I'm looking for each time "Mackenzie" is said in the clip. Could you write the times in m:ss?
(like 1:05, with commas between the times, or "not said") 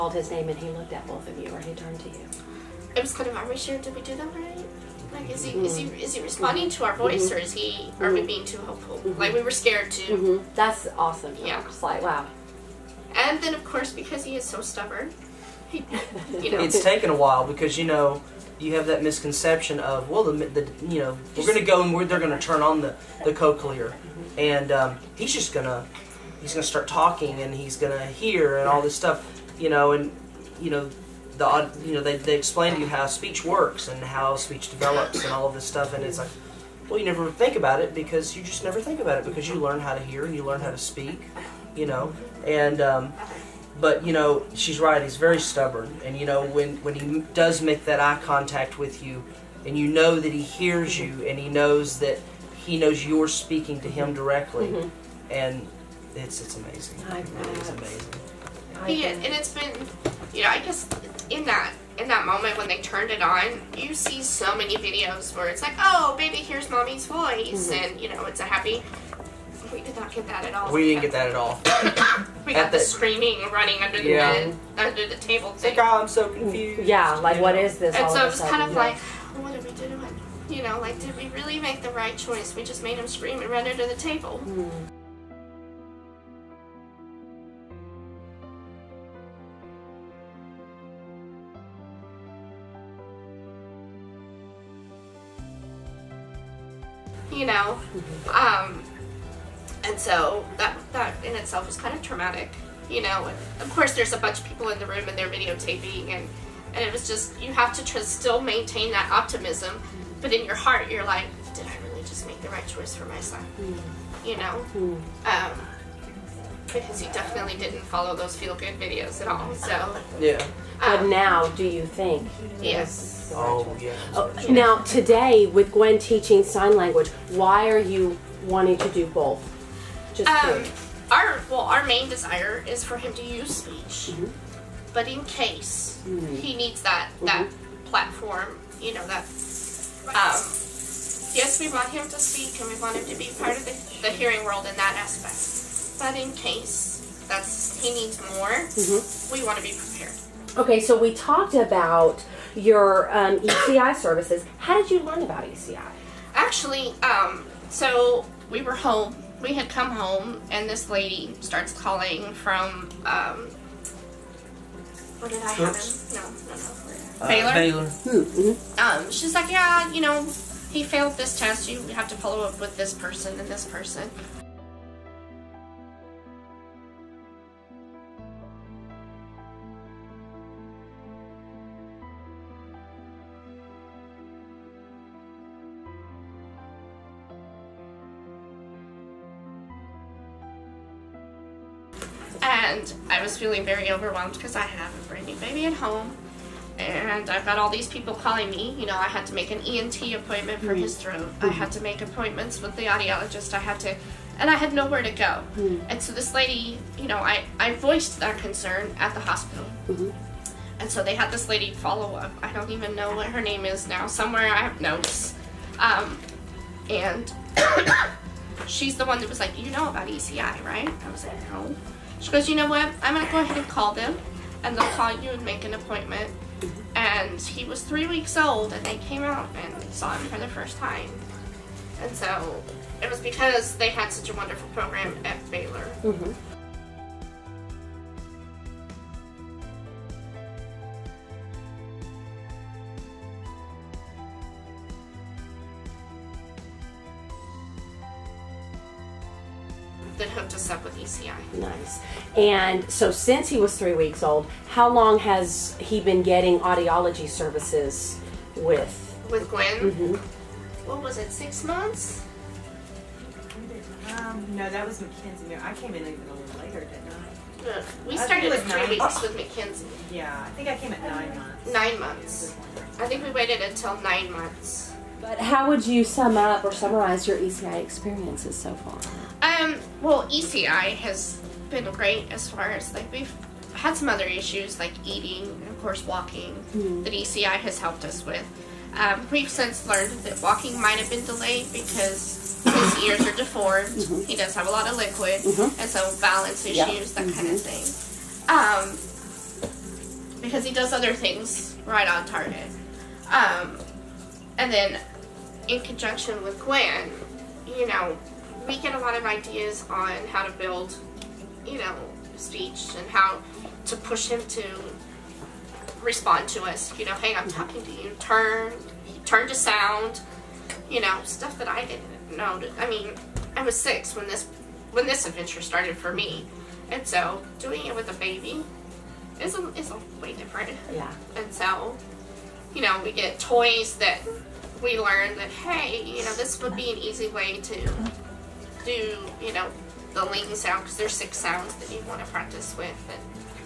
4:25, 4:29.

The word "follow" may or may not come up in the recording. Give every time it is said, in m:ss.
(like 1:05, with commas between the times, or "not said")
1:57, 2:52, 3:31.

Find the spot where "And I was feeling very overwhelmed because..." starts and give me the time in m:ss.
3:12.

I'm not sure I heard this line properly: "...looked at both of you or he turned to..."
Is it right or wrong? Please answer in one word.
right.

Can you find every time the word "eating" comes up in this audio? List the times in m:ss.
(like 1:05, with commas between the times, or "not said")
4:45.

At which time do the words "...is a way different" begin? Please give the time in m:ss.
5:29.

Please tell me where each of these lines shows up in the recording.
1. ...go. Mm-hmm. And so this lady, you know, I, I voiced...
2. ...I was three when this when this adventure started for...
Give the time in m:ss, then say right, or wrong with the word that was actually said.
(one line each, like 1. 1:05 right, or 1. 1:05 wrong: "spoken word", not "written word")
1. 3:25 right
2. 5:23 wrong: "six", not "three".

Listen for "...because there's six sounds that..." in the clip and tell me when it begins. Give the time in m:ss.
5:40.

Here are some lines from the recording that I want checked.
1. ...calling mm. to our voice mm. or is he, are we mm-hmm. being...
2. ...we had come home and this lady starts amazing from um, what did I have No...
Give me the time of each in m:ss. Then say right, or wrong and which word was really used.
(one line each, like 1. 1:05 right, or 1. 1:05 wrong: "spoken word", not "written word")
1. 0:06 wrong: "responding", not "calling"
2. 2:39 wrong: "calling", not "amazing".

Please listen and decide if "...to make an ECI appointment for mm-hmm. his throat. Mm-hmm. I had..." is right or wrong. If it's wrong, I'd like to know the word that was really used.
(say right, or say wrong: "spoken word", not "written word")
wrong: "ENT", not "ECI".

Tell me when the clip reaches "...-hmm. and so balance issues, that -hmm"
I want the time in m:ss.
4:55.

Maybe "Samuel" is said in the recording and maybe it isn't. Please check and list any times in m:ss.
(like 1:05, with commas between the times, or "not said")
not said.